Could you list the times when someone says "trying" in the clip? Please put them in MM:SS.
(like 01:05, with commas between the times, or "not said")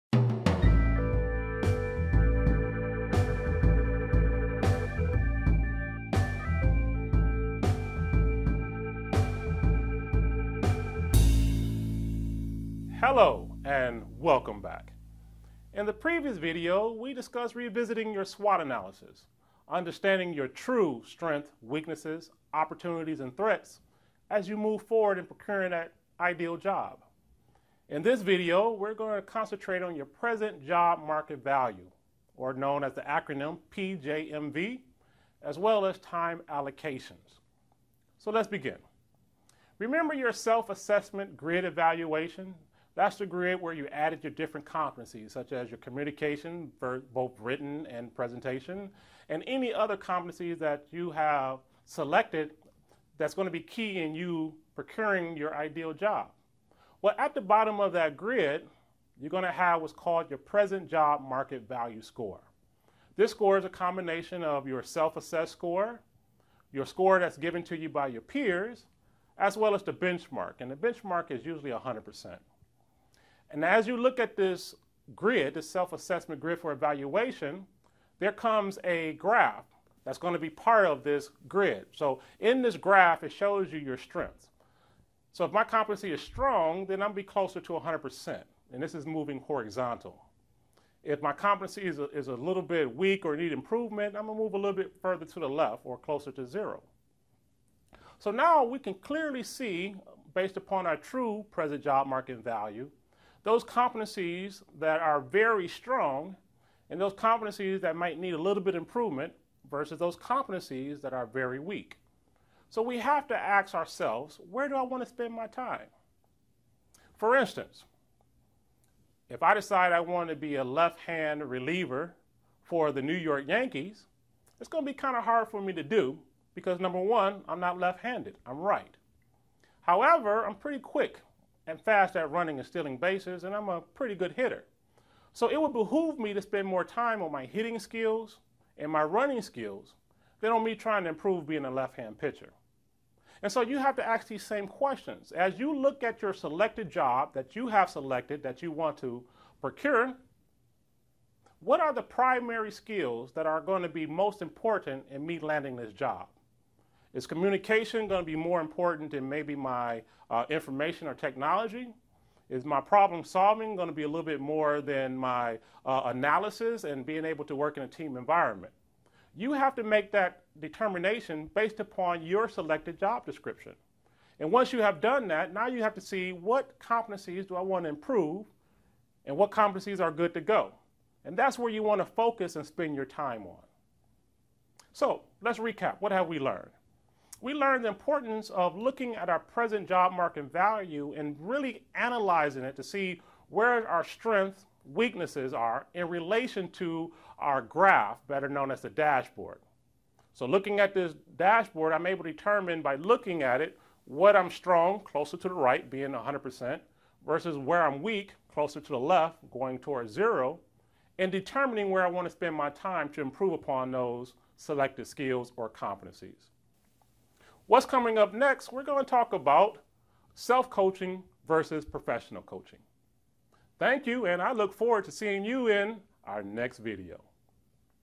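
02:20.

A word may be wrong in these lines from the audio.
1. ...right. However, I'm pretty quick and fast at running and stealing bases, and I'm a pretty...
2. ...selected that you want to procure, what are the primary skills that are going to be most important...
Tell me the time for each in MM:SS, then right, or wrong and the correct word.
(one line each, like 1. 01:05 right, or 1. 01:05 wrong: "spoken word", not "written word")
1. 02:08 right
2. 02:27 right.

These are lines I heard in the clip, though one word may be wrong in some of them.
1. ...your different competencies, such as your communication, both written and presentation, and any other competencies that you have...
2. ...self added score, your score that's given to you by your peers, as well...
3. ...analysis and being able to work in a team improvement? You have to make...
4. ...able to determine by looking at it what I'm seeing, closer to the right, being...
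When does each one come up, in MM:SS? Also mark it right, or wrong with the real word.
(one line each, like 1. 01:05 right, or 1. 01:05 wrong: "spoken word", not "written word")
1. 00:44 right
2. 01:04 wrong: "assessed", not "added"
3. 02:46 wrong: "environment", not "improvement"
4. 03:22 wrong: "strong", not "seeing".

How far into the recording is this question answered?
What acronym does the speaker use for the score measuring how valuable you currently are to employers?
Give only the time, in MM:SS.
00:33.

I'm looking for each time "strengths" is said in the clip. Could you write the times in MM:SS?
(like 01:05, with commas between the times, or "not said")
00:21, 01:23, 03:14.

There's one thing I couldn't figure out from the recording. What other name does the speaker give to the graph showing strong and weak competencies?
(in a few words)
the dashboard.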